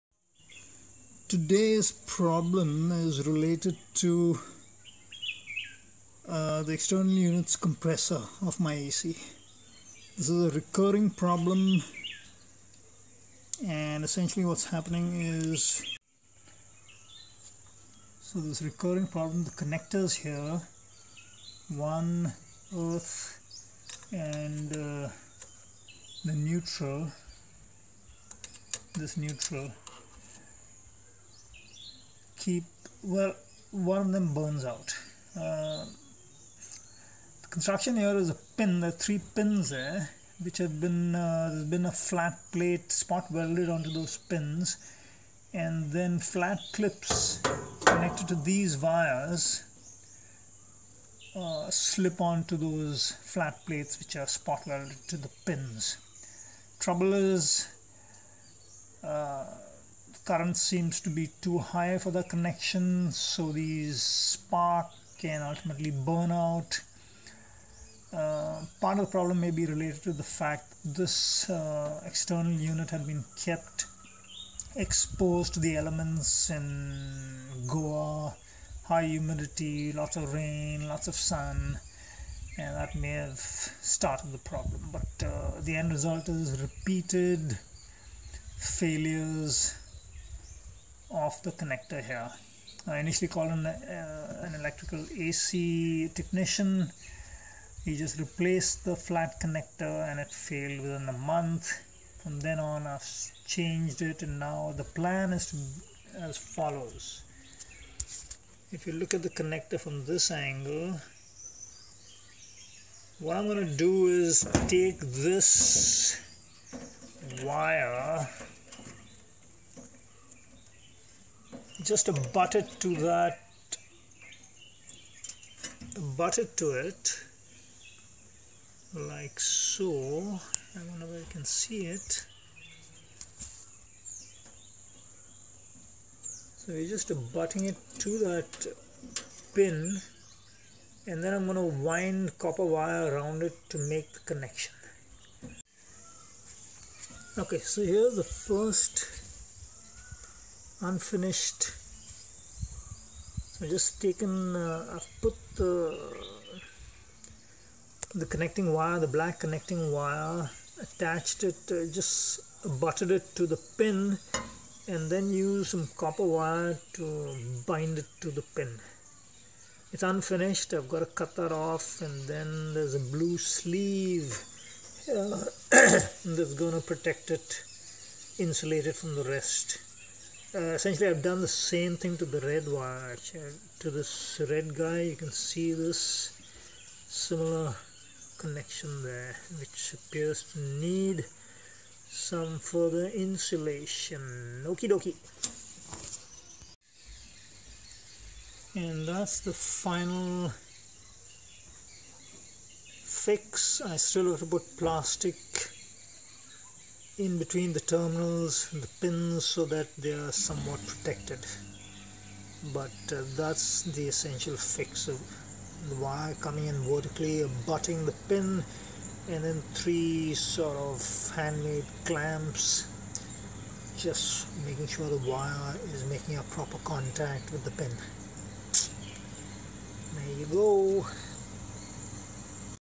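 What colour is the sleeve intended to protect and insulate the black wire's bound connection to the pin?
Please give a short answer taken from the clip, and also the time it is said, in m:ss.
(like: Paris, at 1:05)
Blue, at 2:53.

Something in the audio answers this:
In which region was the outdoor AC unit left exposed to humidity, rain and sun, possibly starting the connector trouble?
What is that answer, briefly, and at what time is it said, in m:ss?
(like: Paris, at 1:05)
Goa, at 1:17.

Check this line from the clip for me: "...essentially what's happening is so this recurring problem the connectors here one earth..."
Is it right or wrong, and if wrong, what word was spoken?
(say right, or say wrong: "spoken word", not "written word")
right.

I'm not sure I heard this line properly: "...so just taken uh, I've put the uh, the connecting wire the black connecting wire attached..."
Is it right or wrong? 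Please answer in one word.
right.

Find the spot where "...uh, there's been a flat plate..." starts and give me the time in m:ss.
0:41.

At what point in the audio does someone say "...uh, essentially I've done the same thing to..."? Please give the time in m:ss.
3:00.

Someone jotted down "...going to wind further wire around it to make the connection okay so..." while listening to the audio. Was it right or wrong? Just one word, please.
wrong.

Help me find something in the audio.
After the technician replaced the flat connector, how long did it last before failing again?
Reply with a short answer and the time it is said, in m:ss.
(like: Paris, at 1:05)
Within a month, at 1:40.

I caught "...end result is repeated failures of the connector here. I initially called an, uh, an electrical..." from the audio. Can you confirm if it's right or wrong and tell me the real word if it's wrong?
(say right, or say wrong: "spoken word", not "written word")
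right.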